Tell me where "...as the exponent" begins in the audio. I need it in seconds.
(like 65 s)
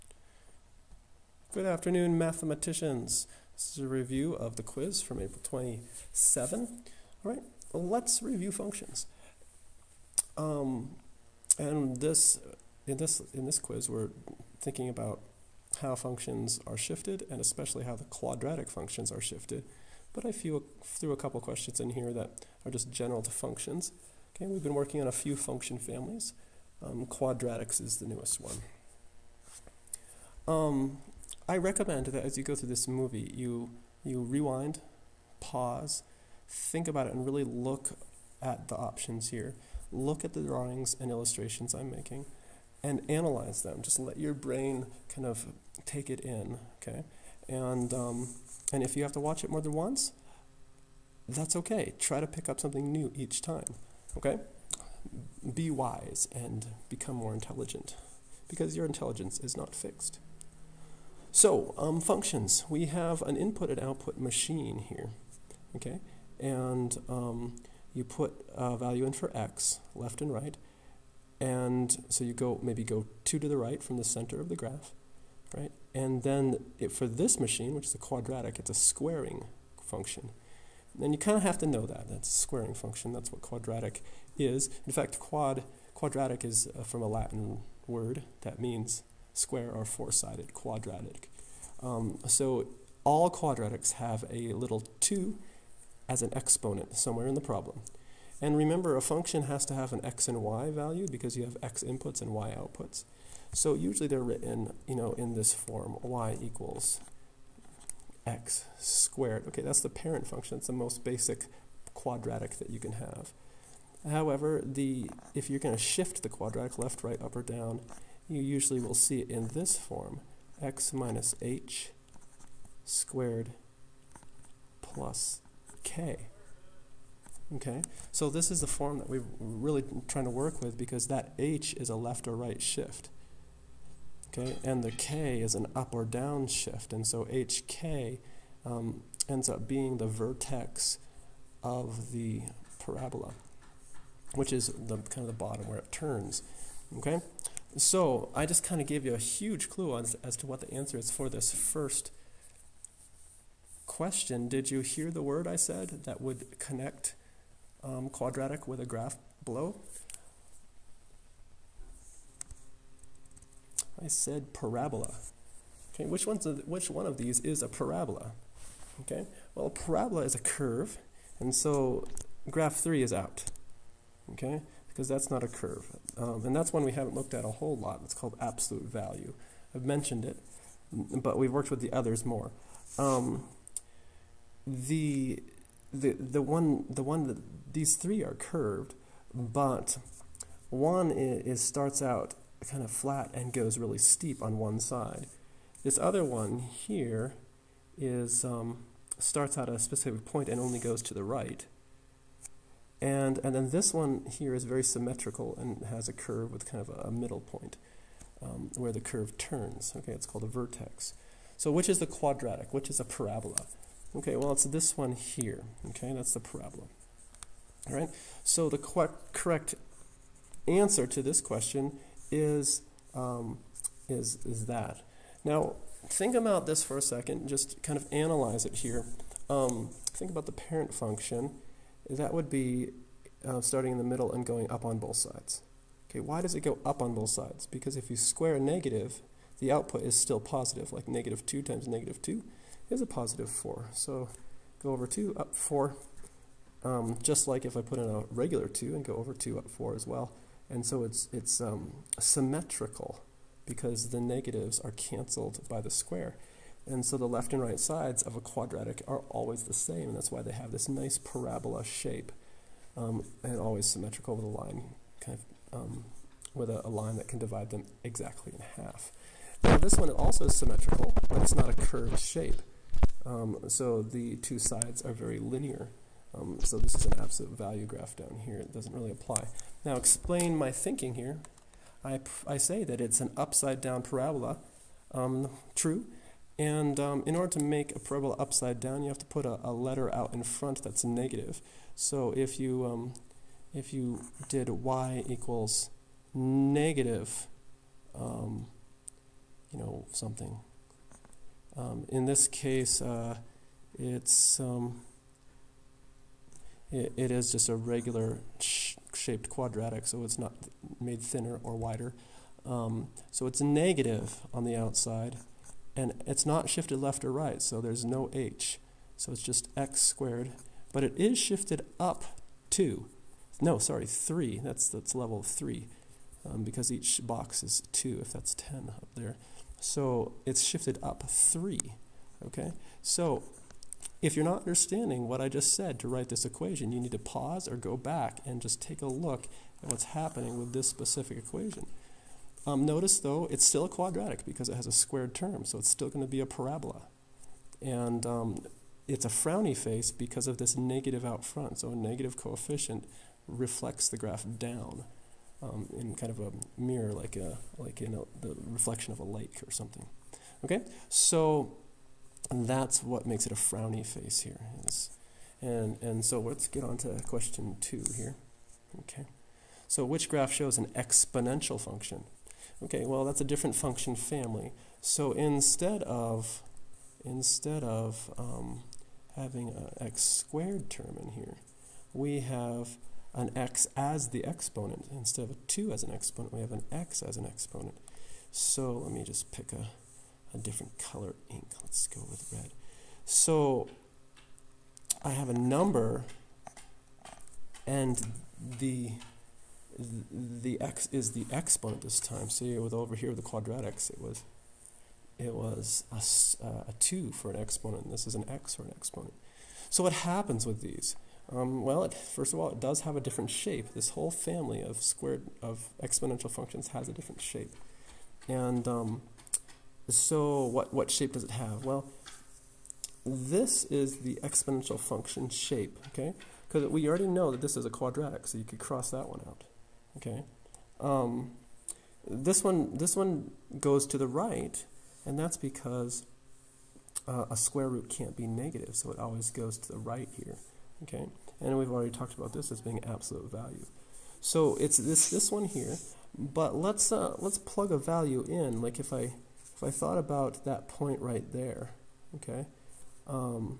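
383 s.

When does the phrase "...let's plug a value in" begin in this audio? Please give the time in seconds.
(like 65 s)
447 s.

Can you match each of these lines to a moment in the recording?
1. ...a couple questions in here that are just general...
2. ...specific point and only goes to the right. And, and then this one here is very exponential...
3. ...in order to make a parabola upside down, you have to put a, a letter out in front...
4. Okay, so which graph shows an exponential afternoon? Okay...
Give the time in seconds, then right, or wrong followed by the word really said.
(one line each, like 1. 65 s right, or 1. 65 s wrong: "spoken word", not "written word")
1. 21 s right
2. 199 s wrong: "symmetrical", not "exponential"
3. 287 s right
4. 368 s wrong: "function", not "afternoon".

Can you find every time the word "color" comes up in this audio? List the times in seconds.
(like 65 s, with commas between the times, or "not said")
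390 s.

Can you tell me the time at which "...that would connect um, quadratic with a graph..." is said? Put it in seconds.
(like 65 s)
156 s.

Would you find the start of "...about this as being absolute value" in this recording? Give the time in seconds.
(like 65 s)
442 s.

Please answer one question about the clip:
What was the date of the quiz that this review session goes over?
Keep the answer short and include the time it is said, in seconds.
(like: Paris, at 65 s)
April 27, at 5 s.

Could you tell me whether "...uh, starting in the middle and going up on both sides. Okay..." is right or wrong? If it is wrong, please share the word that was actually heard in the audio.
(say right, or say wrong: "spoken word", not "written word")
right.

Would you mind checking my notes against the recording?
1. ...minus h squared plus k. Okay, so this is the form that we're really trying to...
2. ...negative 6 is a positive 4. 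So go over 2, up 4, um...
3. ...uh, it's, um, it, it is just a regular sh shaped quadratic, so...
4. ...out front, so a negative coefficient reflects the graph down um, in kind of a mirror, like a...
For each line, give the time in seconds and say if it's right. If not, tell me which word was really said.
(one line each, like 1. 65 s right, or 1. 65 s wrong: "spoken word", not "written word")
1. 120 s right
2. 241 s wrong: "2", not "6"
3. 302 s right
4. 351 s right.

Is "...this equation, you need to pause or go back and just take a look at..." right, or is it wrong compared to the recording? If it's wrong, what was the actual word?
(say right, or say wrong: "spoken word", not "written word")
right.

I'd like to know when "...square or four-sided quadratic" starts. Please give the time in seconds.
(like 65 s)
89 s.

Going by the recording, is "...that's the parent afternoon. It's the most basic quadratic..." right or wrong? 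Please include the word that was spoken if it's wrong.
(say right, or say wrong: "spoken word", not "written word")
wrong: "function", not "afternoon".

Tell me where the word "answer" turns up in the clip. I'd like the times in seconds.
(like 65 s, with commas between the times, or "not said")
150 s, 220 s.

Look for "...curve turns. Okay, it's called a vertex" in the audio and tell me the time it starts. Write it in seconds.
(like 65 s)
208 s.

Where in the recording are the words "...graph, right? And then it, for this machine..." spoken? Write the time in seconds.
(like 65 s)
74 s.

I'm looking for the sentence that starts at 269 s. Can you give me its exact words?
Now this one also is symmetrical, but it's not a curved shape.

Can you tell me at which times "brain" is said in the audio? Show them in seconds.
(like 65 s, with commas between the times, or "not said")
44 s.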